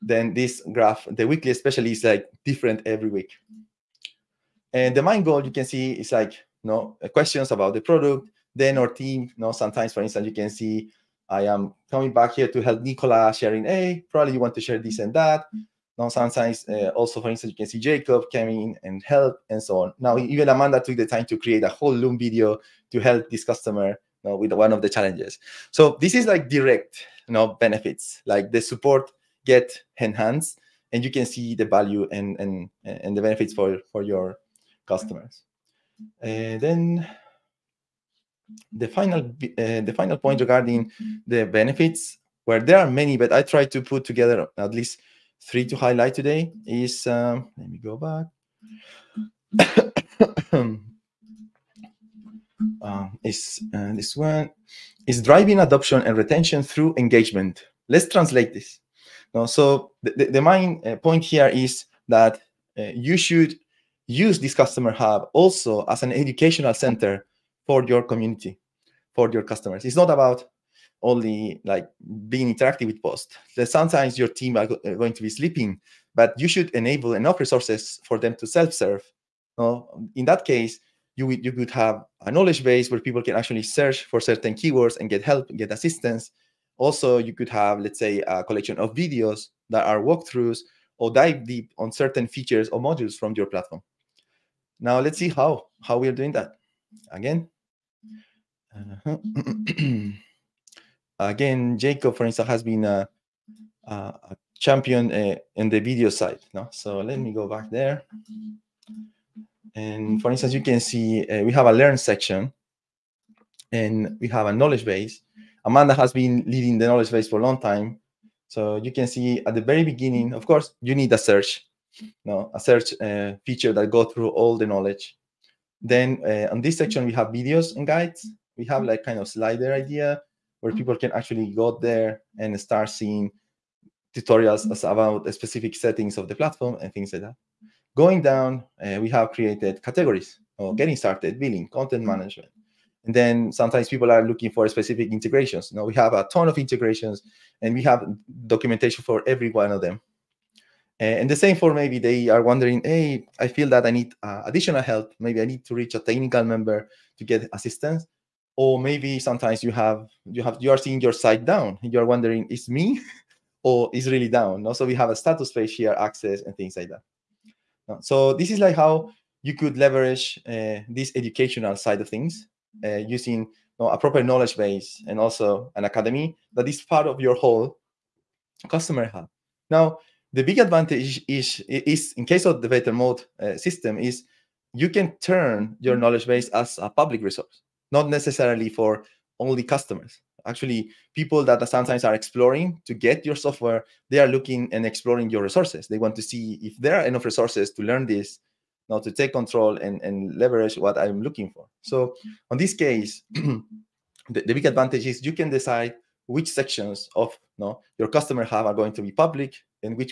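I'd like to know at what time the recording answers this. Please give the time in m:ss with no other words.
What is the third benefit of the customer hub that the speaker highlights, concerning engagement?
0:55.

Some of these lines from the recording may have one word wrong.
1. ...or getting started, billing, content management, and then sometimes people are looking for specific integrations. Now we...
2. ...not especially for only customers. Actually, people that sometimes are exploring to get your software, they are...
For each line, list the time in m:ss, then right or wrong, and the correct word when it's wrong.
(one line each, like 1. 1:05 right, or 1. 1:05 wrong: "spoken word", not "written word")
1. 2:20 right
2. 3:07 wrong: "necessarily", not "especially".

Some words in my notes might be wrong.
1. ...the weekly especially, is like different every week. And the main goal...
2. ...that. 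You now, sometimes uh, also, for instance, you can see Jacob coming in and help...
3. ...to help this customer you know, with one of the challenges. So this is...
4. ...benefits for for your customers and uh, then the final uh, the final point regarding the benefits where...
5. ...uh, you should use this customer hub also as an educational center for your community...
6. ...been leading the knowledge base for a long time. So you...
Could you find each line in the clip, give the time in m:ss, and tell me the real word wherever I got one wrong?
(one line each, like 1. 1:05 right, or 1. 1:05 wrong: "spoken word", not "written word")
1. 0:01 right
2. 0:15 right
3. 0:22 right
4. 0:33 right
5. 1:02 right
6. 1:56 right.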